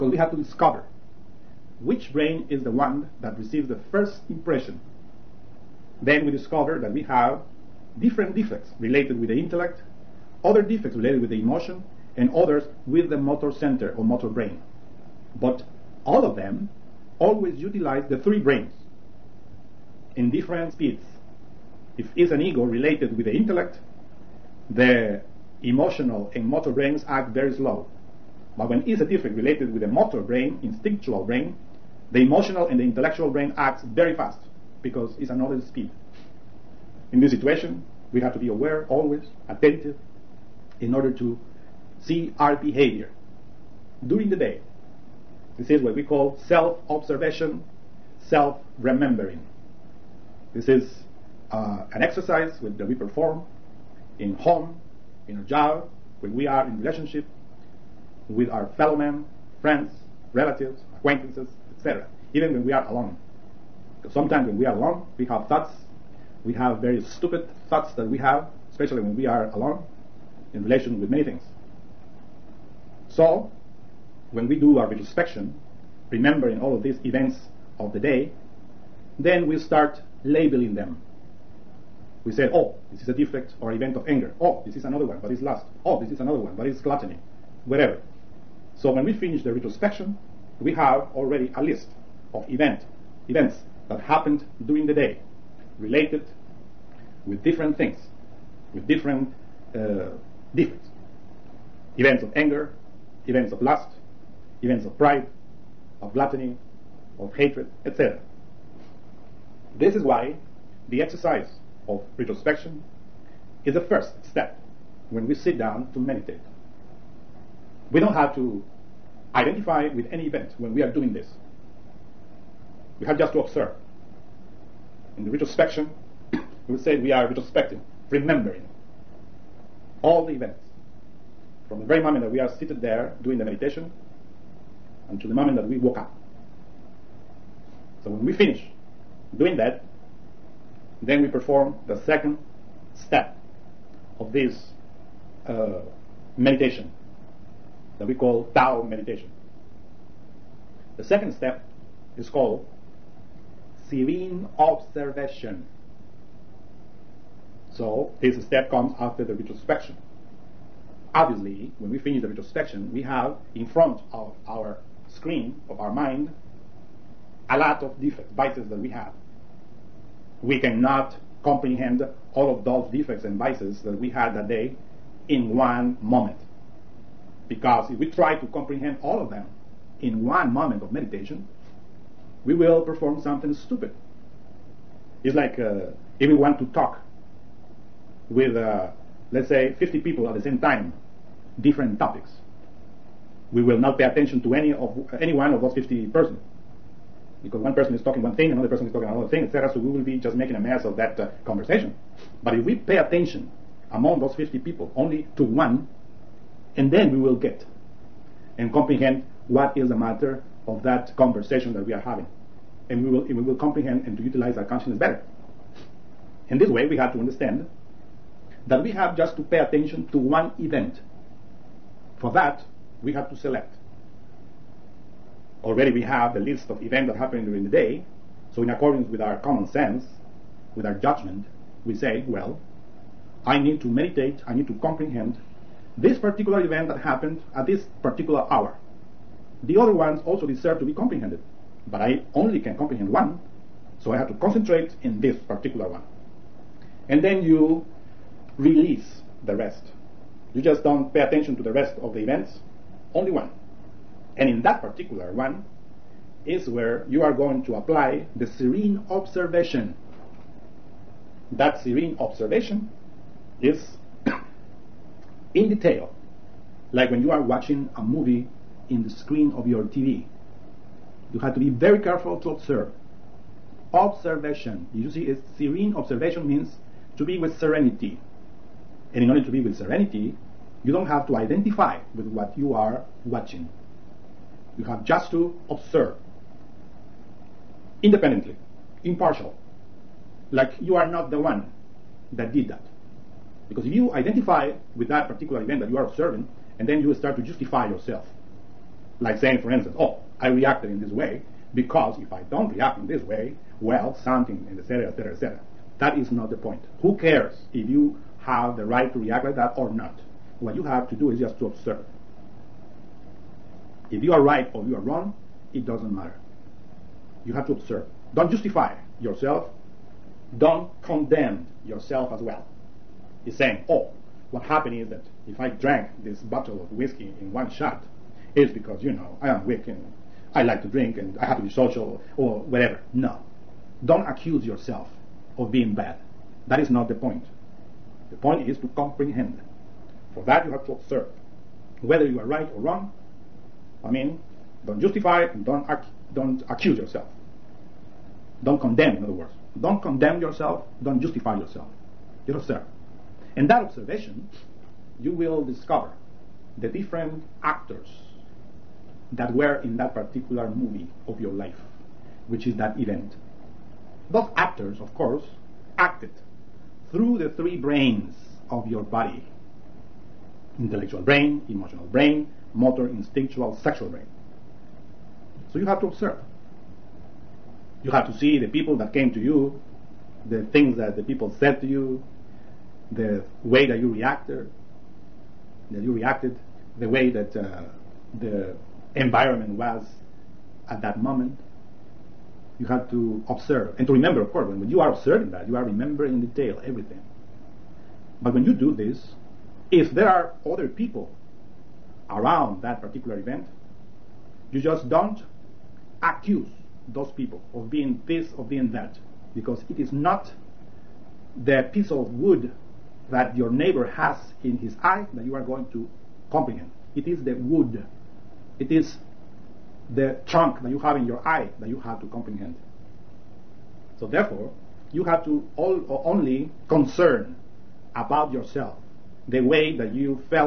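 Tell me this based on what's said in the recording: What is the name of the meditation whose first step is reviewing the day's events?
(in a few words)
Tao meditation.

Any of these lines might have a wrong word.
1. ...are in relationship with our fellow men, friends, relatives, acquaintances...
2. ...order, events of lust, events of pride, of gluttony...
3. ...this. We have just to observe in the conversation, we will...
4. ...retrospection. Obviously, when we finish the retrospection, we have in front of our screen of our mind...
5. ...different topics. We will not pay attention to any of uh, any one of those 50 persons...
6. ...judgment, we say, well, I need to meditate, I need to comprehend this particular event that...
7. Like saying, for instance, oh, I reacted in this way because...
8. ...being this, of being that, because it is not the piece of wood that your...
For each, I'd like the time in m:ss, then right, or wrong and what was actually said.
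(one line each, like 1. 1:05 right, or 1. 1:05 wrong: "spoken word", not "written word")
1. 0:56 right
2. 1:42 wrong: "anger", not "order"
3. 2:01 wrong: "retrospection", not "conversation"
4. 2:39 right
5. 3:11 right
6. 3:50 right
7. 4:59 right
8. 6:47 right.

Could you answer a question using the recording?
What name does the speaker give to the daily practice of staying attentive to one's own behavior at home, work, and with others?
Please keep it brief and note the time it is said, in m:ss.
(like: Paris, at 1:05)
self remembering, at 0:48.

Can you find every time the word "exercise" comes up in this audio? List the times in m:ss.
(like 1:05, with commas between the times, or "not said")
0:52, 1:51.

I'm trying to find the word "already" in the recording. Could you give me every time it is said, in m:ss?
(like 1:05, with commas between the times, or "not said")
1:31, 3:45.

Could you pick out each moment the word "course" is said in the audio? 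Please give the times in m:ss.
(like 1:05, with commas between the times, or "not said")
6:05, 6:34.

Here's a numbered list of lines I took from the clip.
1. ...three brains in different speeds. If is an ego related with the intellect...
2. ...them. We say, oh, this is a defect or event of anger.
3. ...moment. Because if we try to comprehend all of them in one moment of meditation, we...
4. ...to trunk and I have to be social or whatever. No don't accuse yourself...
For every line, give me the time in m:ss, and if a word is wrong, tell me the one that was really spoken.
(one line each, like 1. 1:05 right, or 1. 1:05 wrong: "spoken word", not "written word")
1. 0:18 right
2. 1:20 right
3. 2:56 right
4. 5:30 wrong: "drink", not "trunk".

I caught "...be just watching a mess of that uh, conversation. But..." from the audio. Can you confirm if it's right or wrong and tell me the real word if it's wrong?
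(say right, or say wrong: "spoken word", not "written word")
wrong: "making", not "watching".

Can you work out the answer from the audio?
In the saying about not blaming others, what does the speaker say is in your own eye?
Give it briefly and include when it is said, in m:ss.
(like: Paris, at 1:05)
the trunk, at 6:58.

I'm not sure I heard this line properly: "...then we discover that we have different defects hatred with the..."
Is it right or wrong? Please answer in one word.
wrong.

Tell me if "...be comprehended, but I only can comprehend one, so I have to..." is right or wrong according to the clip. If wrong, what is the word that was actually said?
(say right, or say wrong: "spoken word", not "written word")
right.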